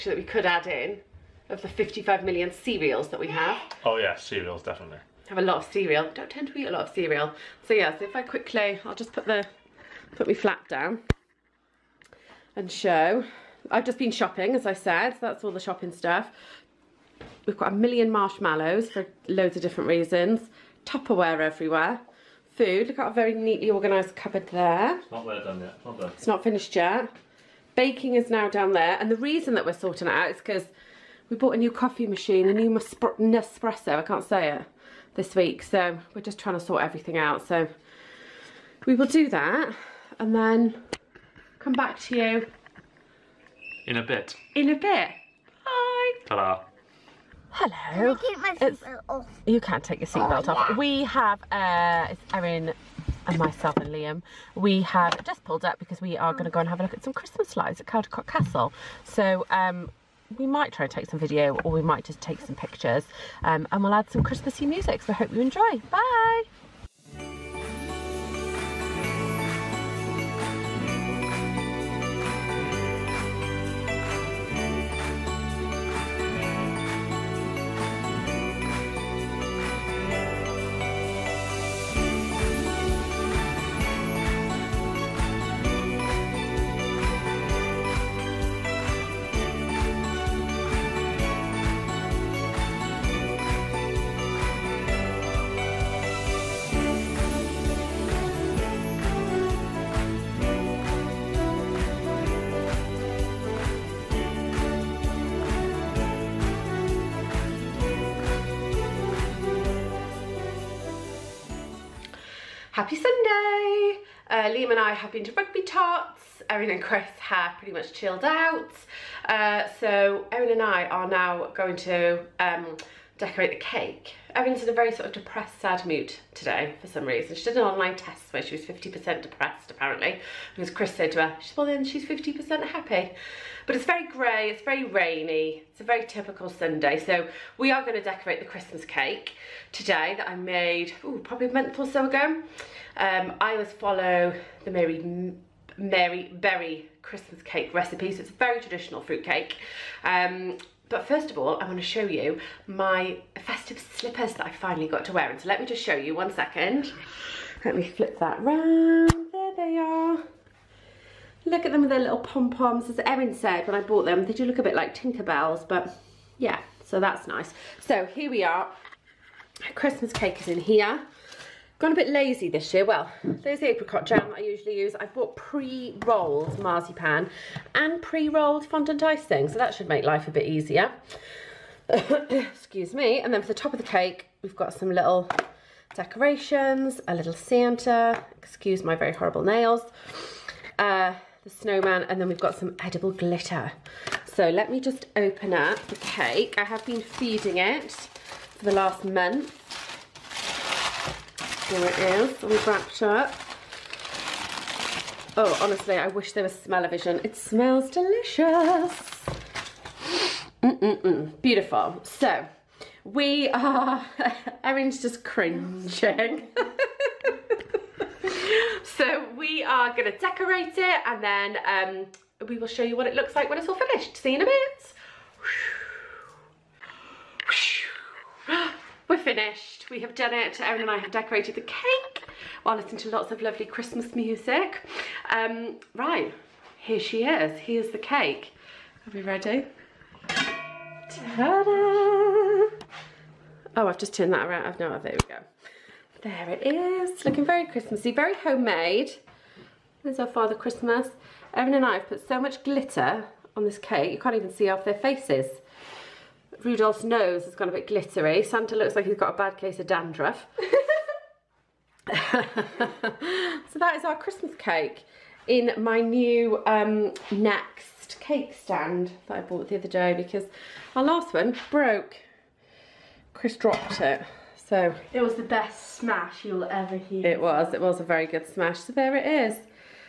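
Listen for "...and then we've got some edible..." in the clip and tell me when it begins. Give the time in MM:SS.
03:12.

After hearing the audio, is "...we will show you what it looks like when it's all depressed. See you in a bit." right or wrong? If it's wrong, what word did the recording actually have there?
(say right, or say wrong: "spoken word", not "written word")
wrong: "finished", not "depressed".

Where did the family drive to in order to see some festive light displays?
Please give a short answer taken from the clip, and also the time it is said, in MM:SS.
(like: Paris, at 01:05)
Caldicot Castle, at 00:57.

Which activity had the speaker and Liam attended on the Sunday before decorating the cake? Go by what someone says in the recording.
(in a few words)
Rugby tots.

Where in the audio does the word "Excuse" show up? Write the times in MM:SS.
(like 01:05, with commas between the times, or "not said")
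03:01, 03:08.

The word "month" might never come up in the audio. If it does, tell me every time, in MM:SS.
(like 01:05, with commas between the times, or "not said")
02:21, 03:19.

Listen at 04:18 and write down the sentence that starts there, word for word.
Santa looks like he's got a bad case of dandruff.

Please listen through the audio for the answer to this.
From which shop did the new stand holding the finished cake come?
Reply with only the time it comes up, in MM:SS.
04:27.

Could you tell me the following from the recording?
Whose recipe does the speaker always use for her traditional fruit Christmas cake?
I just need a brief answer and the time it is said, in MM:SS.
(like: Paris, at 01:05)
Mary Berry, at 02:25.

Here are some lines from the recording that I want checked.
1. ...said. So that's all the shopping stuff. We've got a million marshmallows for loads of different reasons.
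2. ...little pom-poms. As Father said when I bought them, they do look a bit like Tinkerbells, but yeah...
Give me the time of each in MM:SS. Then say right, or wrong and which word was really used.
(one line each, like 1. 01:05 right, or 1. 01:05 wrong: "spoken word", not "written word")
1. 00:14 right
2. 02:41 wrong: "Erin", not "Father".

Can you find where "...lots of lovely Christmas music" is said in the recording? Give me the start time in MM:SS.
03:53.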